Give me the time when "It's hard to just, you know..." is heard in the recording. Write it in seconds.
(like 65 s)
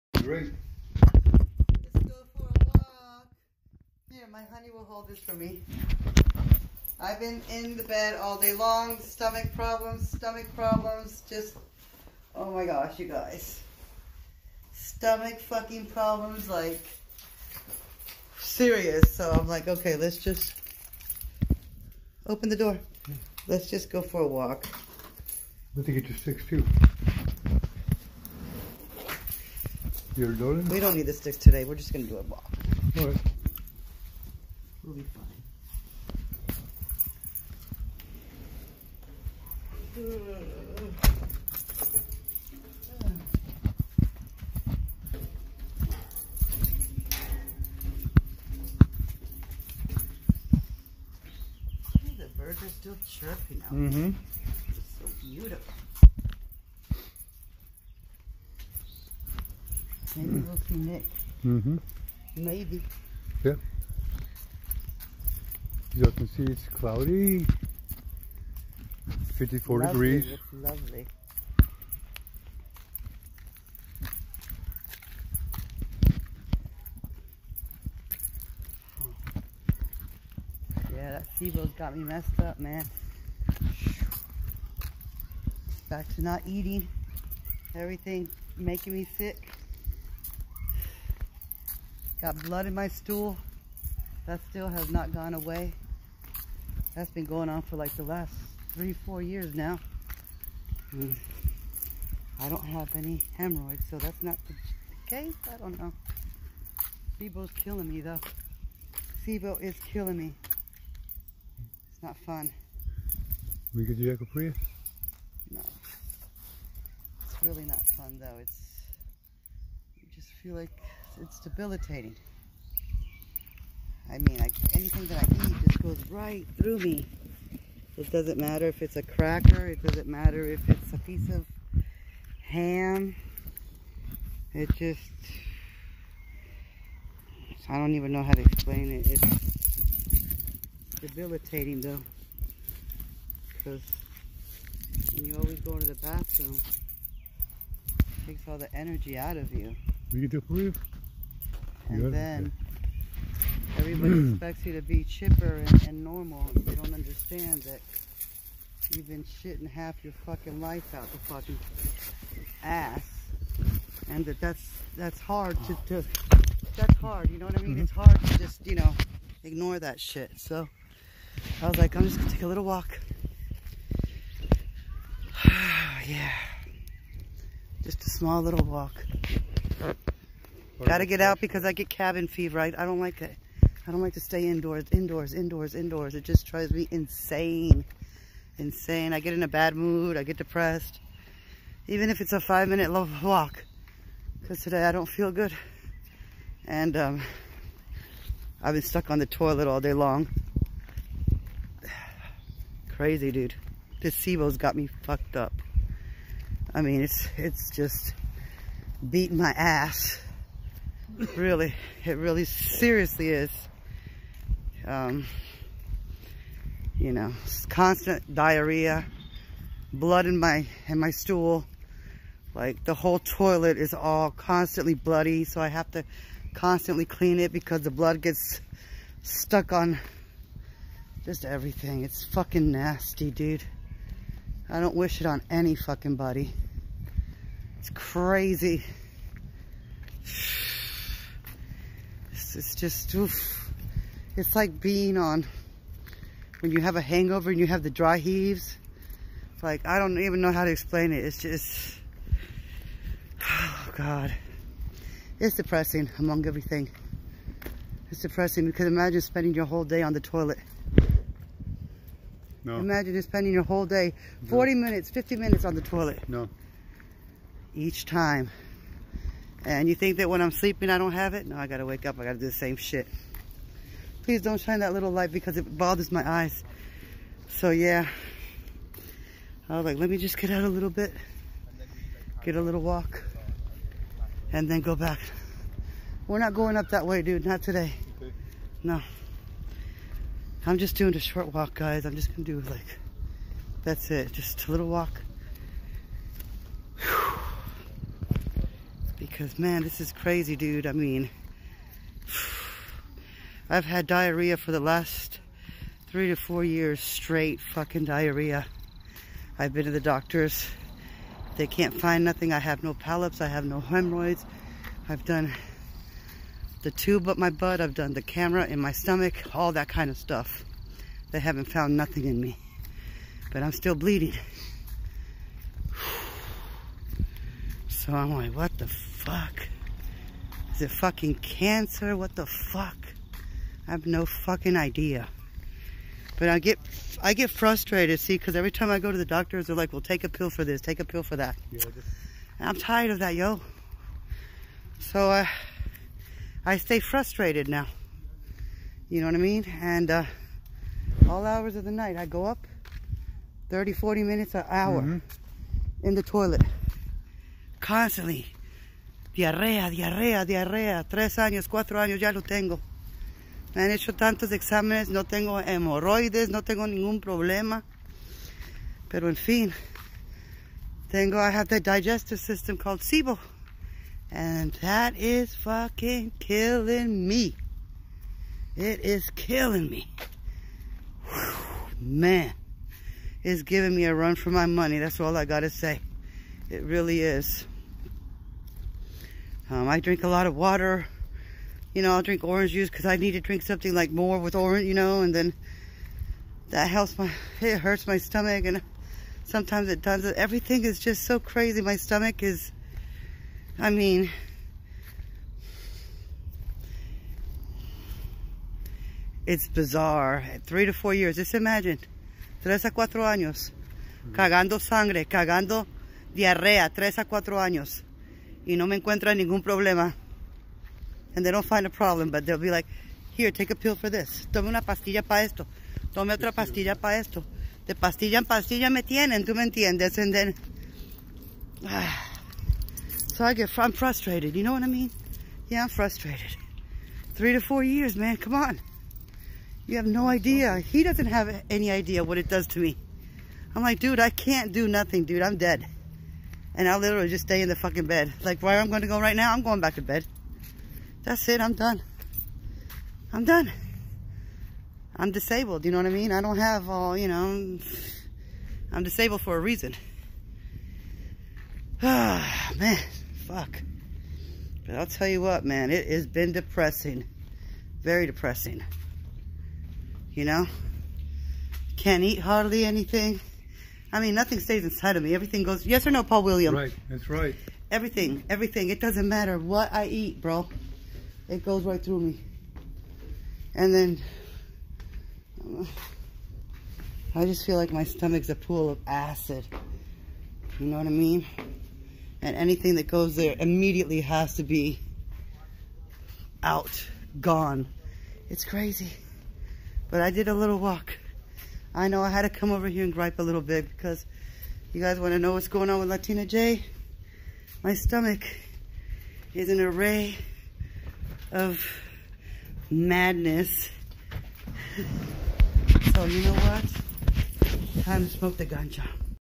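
167 s.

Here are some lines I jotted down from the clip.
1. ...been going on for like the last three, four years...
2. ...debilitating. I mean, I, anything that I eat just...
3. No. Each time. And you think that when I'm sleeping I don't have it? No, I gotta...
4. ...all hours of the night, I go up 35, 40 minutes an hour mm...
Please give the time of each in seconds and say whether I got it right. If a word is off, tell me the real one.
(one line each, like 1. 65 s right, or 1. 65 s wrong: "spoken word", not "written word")
1. 97 s right
2. 121 s right
3. 266 s right
4. 351 s wrong: "30", not "35".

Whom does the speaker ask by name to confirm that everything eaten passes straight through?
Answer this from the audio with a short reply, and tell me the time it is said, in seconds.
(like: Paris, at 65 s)
Paul William, at 476 s.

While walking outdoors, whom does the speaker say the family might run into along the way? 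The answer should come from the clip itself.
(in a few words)
Nick.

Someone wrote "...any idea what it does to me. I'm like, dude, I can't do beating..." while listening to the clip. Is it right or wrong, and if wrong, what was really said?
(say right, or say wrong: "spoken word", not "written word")
wrong: "nothing", not "beating".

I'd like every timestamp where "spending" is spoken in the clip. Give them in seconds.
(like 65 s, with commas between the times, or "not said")
259 s, 263 s.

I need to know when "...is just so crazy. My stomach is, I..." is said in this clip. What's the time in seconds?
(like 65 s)
400 s.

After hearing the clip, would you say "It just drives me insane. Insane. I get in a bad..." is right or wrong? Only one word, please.
right.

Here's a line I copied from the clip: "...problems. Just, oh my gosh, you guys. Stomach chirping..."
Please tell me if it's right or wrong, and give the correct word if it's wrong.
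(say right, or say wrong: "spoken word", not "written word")
wrong: "fucking", not "chirping".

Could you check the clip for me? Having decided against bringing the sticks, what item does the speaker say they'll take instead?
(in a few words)
A ball.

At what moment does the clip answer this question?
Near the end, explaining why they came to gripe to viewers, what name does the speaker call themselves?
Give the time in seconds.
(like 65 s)
506 s.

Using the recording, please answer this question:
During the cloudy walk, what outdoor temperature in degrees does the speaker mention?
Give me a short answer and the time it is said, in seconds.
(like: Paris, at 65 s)
54, at 69 s.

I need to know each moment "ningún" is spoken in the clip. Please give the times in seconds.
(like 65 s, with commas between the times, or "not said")
366 s, 419 s.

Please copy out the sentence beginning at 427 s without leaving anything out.
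De pastilla en pastilla me tienen, tú me entiendes.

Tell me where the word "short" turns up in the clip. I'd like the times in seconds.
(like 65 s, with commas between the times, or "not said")
291 s.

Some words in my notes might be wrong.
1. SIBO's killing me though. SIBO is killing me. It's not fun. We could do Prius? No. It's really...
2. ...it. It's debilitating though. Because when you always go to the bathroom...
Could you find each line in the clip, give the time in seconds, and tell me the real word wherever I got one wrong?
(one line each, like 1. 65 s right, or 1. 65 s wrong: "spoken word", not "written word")
1. 107 s right
2. 138 s right.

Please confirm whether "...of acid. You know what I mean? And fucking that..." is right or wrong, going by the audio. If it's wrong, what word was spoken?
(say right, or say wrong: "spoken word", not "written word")
wrong: "anything", not "fucking".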